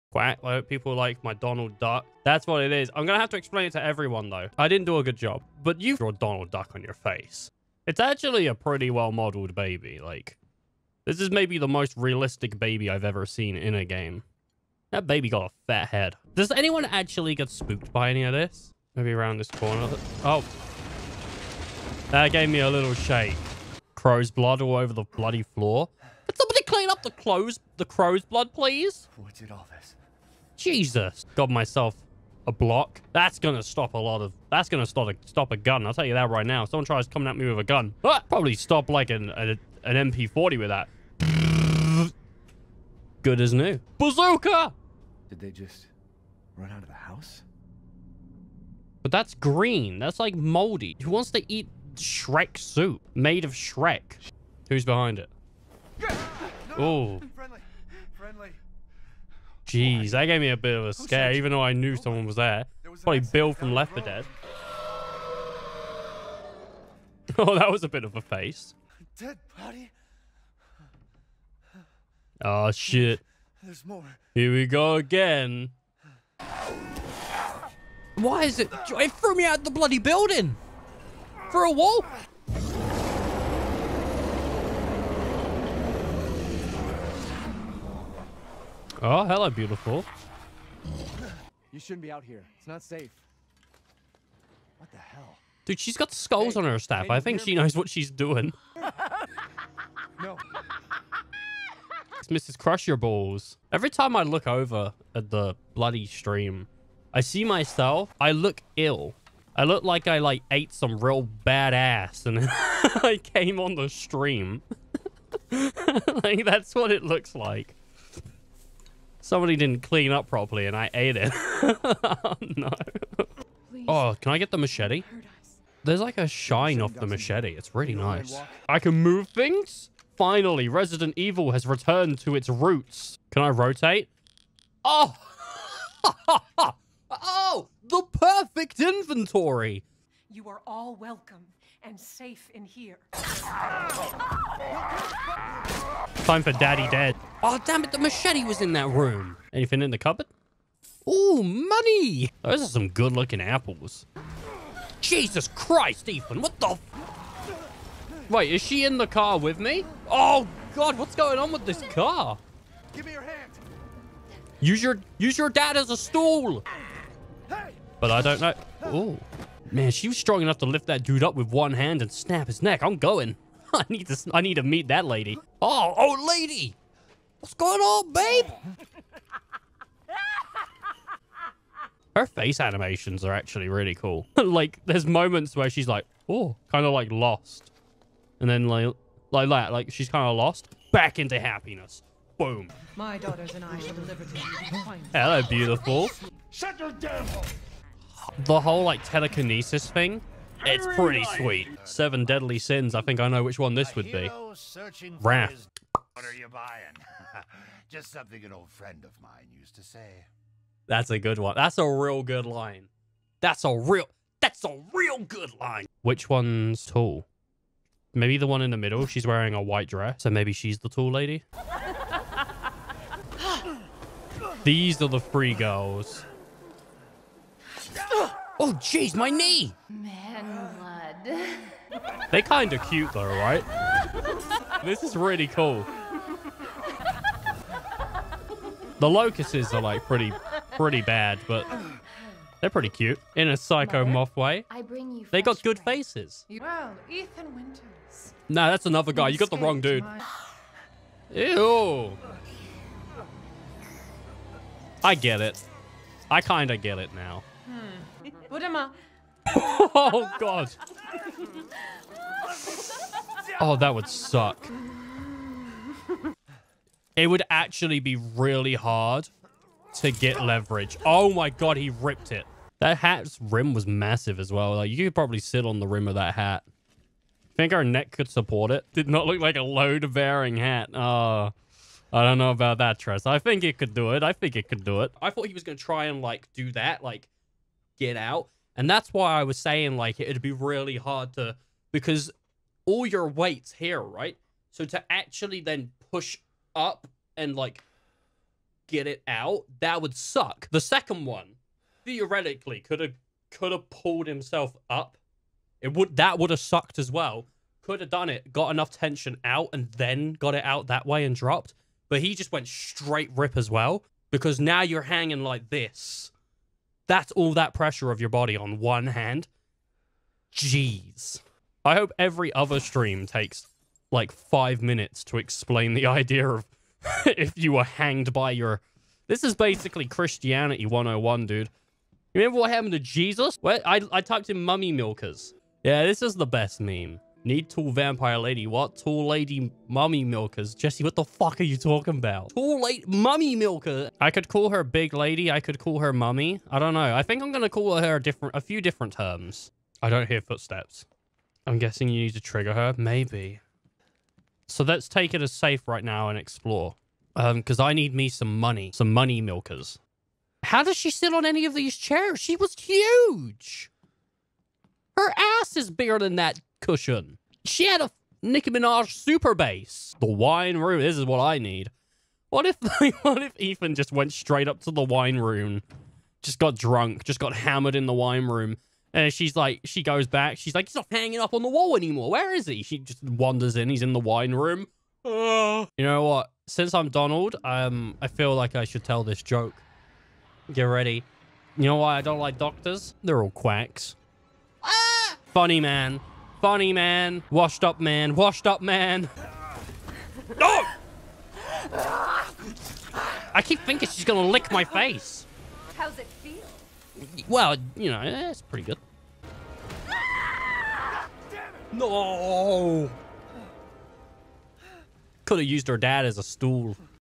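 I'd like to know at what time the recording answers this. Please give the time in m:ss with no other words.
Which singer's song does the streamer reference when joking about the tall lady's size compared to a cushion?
6:08.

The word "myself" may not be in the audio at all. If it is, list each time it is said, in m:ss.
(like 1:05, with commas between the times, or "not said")
0:31, 1:47.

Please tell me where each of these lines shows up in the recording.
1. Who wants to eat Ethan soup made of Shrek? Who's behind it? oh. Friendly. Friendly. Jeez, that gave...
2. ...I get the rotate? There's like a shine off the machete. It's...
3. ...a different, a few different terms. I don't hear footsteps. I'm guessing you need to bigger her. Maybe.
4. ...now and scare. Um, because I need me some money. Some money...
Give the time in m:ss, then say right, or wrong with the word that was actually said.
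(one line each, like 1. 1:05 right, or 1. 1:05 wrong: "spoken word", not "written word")
1. 0:51 wrong: "Shrek", not "Ethan"
2. 2:04 wrong: "machete", not "rotate"
3. 5:48 wrong: "trigger", not "bigger"
4. 5:56 wrong: "explore", not "scare".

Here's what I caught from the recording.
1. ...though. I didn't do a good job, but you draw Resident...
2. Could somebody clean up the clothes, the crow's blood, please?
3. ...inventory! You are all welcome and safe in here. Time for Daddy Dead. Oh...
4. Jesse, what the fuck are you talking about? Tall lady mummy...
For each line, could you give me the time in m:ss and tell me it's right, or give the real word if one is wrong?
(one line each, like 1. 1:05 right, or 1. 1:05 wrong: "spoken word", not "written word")
1. 0:04 wrong: "Donald", not "Resident"
2. 0:26 right
3. 2:18 right
4. 5:40 right.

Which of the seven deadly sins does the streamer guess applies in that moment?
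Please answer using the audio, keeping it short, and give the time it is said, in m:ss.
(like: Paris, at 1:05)
Wrath, at 3:25.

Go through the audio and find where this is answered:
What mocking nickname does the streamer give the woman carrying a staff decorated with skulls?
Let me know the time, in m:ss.
1:42.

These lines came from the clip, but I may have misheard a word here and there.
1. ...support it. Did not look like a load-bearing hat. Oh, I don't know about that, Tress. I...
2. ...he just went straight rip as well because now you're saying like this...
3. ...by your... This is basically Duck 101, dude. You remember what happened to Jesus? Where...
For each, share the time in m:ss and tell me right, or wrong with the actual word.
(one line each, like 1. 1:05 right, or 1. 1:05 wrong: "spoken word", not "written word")
1. 4:38 right
2. 5:12 wrong: "hanging", not "saying"
3. 5:28 wrong: "Christianity", not "Duck".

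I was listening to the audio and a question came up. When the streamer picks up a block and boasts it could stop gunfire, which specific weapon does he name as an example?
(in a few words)
MP40.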